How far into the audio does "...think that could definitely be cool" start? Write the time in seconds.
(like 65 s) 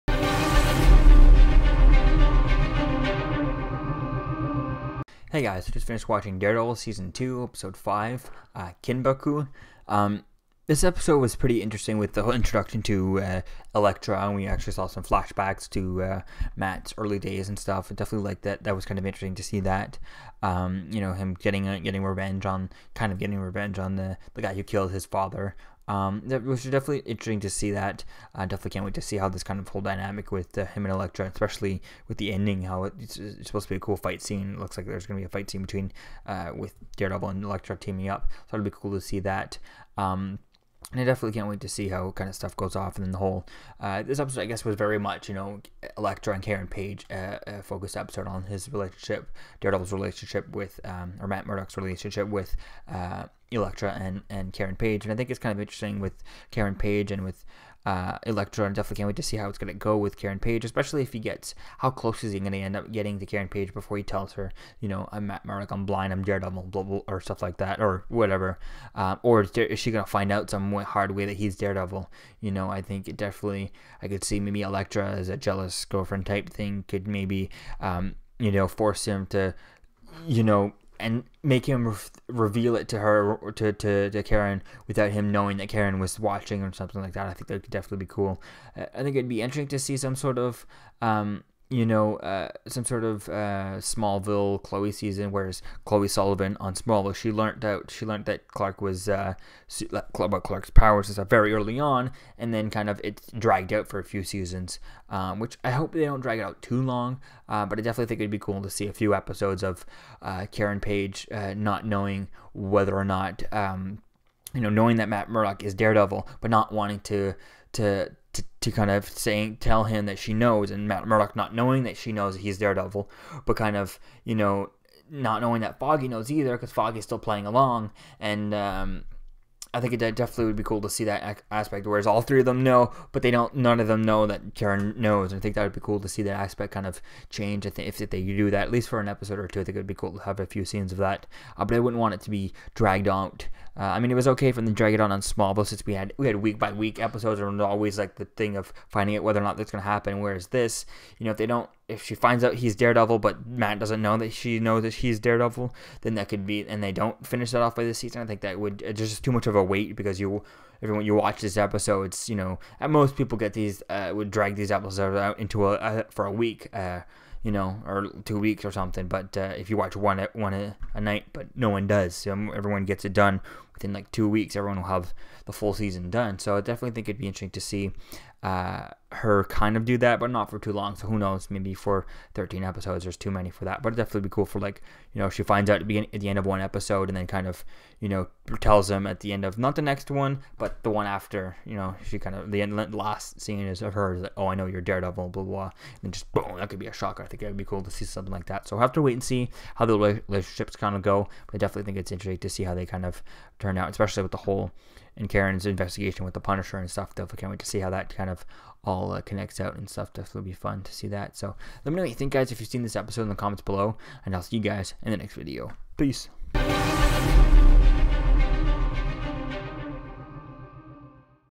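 87 s.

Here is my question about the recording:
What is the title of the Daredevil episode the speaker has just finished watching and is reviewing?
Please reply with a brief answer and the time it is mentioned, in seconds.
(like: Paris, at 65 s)
Kinbaku, at 8 s.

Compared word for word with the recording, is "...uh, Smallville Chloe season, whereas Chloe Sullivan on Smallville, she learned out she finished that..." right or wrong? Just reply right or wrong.
wrong.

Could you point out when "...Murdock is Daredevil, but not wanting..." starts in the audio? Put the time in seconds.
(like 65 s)
115 s.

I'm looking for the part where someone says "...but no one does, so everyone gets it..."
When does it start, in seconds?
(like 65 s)
171 s.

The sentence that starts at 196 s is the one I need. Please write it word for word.
And just boom, that could be a shocker.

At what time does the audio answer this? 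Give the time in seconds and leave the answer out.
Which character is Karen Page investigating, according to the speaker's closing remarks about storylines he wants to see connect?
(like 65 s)
206 s.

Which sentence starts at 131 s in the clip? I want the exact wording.
Whereas all three of them know, but they don't.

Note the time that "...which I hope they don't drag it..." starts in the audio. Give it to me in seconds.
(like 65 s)
105 s.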